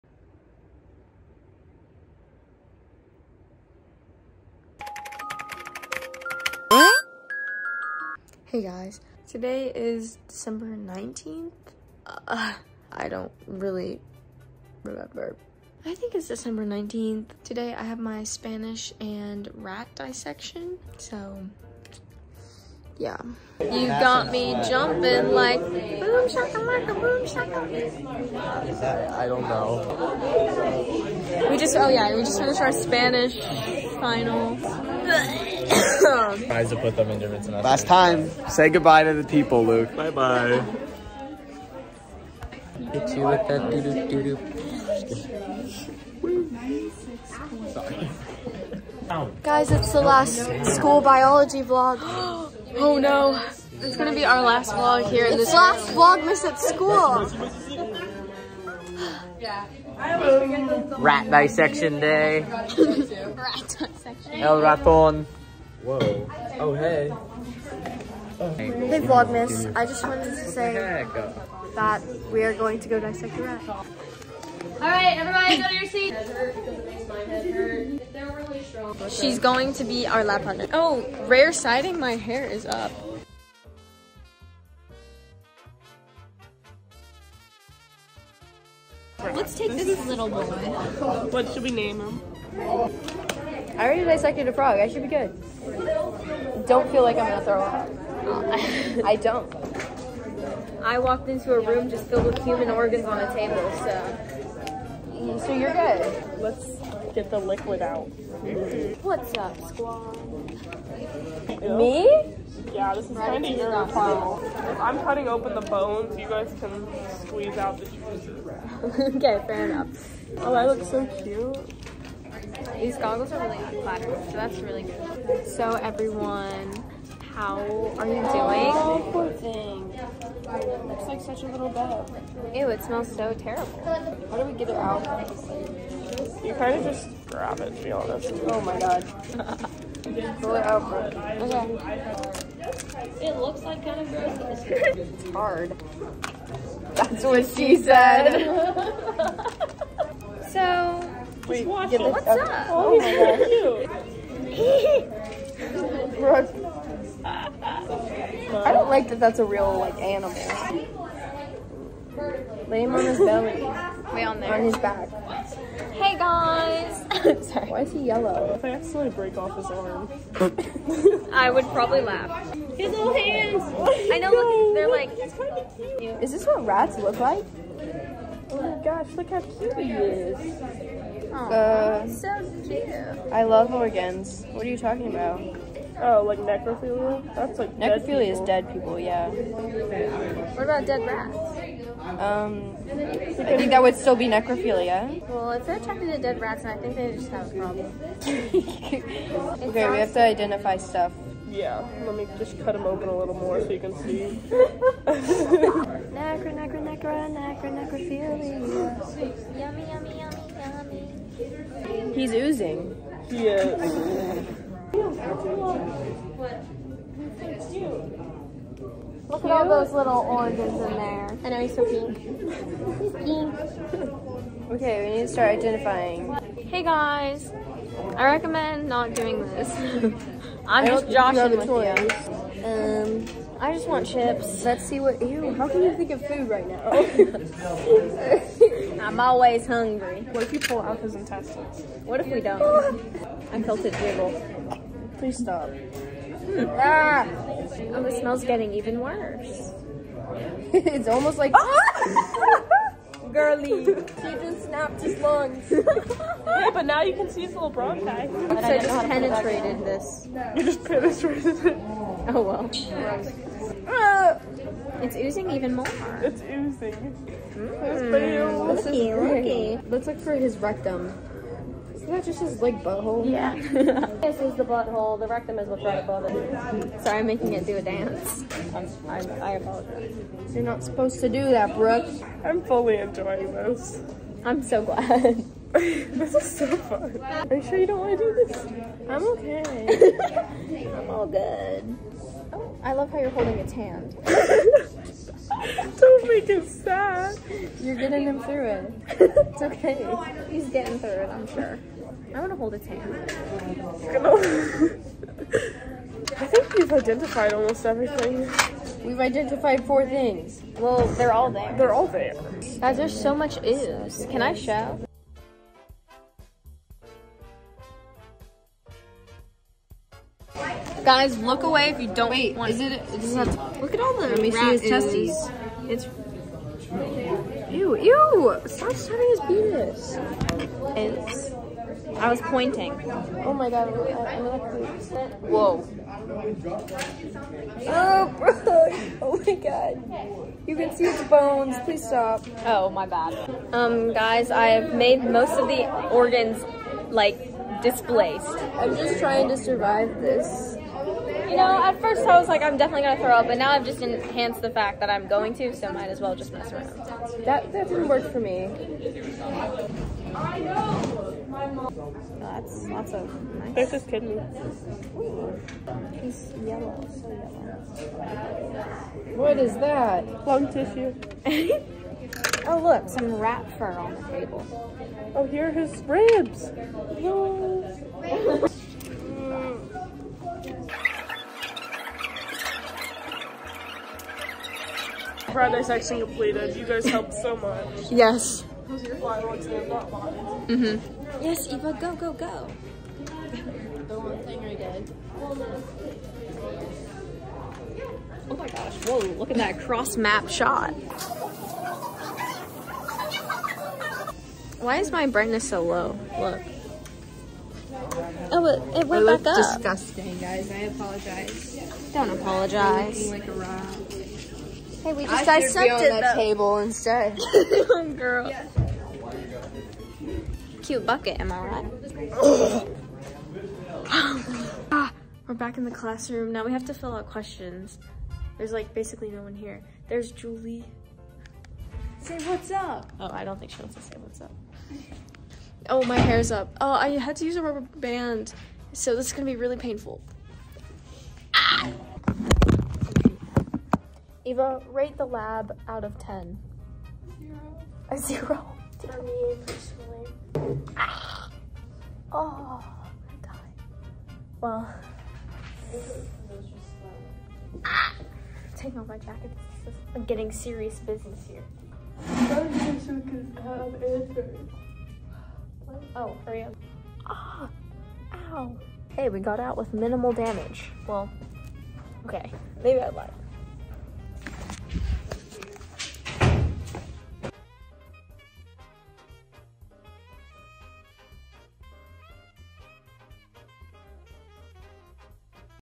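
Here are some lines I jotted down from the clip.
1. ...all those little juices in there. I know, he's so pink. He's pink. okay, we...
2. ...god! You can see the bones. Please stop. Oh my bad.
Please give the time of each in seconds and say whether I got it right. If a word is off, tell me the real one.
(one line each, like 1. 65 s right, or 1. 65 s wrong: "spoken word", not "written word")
1. 219 s wrong: "oranges", not "juices"
2. 339 s right.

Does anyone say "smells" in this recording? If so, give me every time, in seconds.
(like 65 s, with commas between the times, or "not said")
132 s, 248 s.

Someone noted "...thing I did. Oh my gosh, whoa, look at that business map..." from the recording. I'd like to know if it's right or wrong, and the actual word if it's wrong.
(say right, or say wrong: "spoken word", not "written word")
wrong: "cross", not "business".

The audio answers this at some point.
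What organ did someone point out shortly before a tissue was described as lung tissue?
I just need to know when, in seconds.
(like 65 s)
364 s.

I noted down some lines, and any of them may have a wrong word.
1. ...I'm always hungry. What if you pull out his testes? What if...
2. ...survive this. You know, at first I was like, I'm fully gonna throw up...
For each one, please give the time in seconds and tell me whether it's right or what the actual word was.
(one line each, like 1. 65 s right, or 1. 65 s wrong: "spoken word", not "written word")
1. 239 s wrong: "intestines", not "testes"
2. 349 s wrong: "definitely", not "fully".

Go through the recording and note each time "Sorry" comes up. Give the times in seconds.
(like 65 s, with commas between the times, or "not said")
167 s, 277 s.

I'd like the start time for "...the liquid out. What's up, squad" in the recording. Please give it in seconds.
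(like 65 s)
107 s.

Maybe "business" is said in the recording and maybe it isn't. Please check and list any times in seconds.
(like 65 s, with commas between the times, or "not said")
460 s.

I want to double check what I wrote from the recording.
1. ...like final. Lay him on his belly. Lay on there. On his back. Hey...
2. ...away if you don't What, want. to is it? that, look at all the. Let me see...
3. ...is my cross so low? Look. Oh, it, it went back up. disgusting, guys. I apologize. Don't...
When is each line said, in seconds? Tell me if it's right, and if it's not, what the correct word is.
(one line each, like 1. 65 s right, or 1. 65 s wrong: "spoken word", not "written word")
1. 159 s wrong: "animal", not "final"
2. 321 s wrong: "Wait", not "What"
3. 404 s wrong: "brightness", not "cross".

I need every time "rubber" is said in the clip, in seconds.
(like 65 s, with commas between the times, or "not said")
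437 s.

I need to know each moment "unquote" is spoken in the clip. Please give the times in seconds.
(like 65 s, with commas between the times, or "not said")
not said.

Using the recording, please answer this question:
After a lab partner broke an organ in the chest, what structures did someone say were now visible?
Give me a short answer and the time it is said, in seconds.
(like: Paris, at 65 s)
Bronchi, at 257 s.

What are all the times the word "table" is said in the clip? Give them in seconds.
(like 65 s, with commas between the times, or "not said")
103 s, 374 s, 416 s.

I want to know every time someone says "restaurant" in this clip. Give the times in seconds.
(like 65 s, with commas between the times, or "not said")
not said.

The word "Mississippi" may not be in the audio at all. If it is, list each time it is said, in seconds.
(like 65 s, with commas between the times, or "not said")
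not said.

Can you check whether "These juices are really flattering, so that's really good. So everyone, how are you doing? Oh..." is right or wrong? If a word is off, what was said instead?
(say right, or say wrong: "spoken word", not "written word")
wrong: "goggles", not "juices".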